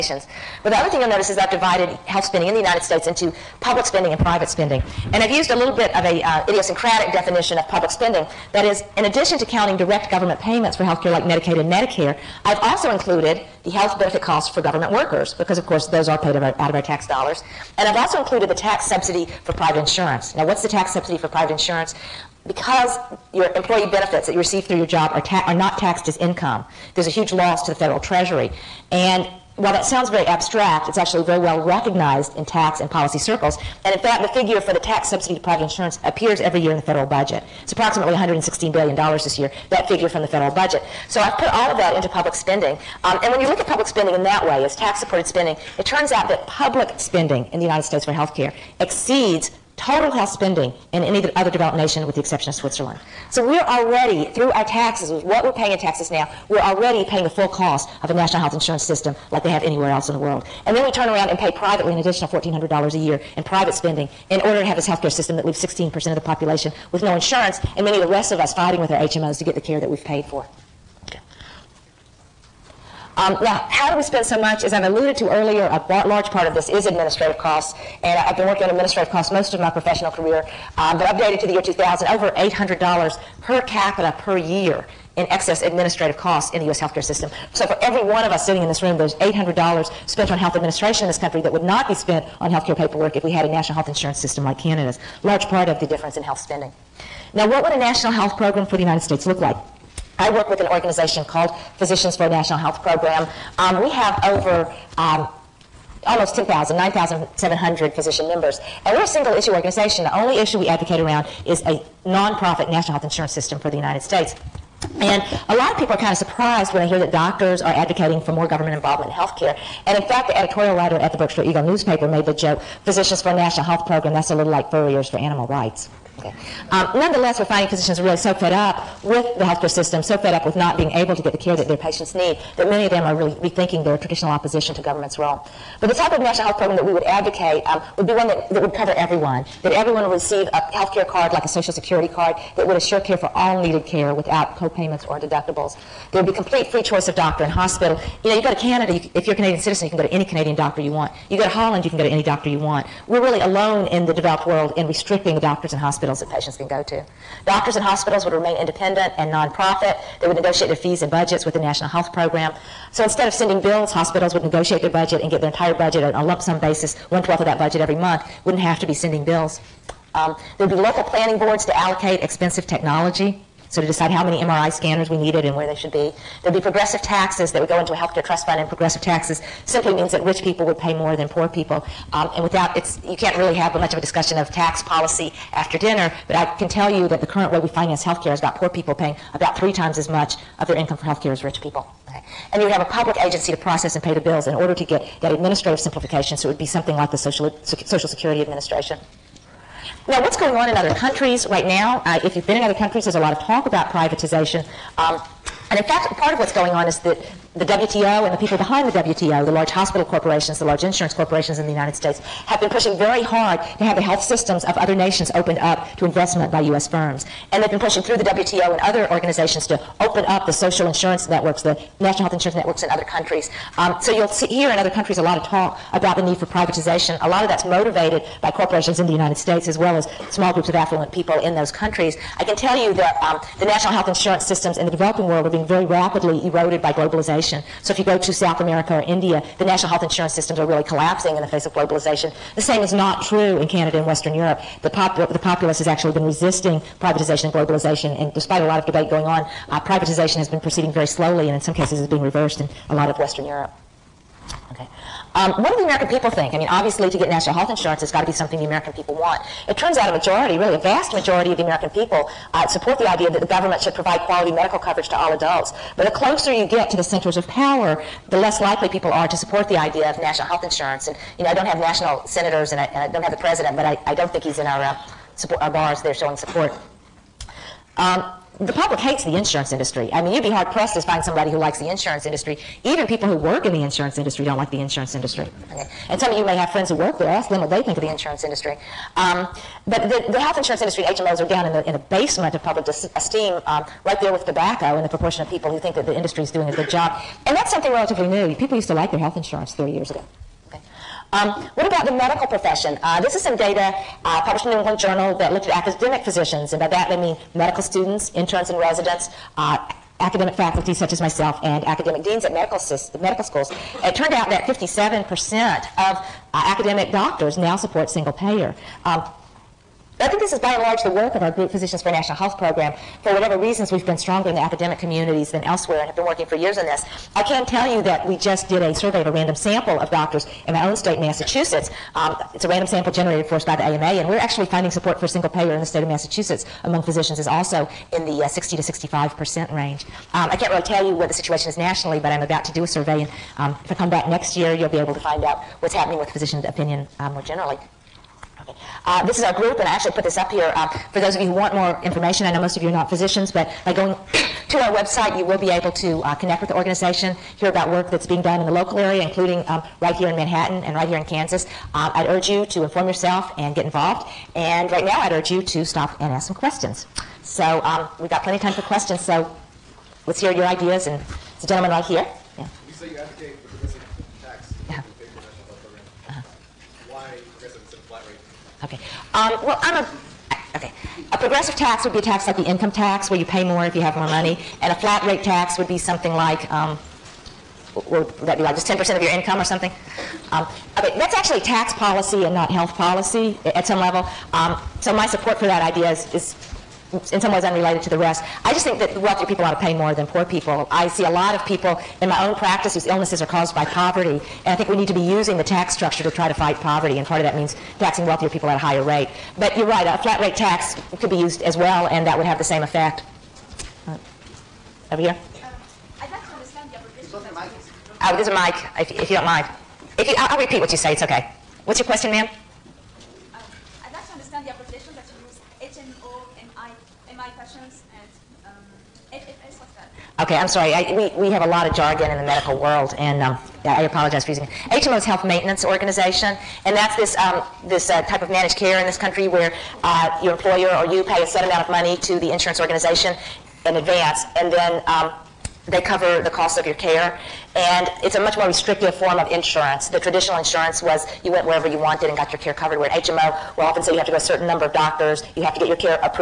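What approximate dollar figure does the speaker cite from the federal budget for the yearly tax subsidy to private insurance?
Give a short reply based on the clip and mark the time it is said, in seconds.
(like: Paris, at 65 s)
$116 billion, at 38 s.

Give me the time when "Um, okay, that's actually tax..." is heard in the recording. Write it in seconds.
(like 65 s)
390 s.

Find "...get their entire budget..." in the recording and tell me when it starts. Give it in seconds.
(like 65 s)
165 s.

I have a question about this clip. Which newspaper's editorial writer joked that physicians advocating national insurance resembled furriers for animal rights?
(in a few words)
Berkshire Eagle.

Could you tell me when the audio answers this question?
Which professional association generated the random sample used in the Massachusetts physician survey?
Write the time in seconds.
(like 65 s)
333 s.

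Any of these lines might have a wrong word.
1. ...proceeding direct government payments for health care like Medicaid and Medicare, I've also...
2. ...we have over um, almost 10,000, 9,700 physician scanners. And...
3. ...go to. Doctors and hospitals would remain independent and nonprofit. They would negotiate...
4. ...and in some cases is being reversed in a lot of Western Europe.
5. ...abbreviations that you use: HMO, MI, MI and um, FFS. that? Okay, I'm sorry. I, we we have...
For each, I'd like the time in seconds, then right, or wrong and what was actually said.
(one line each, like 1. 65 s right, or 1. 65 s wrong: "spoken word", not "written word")
1. 9 s wrong: "counting", not "proceeding"
2. 103 s wrong: "members", not "scanners"
3. 156 s right
4. 251 s right
5. 424 s right.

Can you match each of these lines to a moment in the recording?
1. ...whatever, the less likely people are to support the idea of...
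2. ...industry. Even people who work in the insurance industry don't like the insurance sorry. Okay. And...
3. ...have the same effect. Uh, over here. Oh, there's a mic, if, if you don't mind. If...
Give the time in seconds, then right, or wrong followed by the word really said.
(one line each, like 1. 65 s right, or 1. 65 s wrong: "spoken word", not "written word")
1. 267 s wrong: "power", not "whatever"
2. 282 s wrong: "industry", not "sorry"
3. 412 s right.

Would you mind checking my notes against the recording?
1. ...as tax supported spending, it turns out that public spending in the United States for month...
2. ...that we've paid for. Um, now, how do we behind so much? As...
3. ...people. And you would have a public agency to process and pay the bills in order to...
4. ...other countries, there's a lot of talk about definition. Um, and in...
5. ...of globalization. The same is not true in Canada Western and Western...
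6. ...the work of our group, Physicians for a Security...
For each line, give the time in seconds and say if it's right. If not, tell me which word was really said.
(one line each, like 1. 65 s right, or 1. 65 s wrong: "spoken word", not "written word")
1. 44 s wrong: "health", not "month"
2. 69 s wrong: "spend", not "behind"
3. 191 s right
4. 202 s wrong: "privatization", not "definition"
5. 241 s wrong: "Canada", not "Western"
6. 321 s wrong: "National", not "Security".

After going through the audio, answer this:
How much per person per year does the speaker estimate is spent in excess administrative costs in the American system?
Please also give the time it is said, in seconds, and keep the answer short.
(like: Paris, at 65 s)
$800, at 82 s.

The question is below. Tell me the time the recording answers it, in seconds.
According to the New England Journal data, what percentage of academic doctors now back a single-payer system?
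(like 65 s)
314 s.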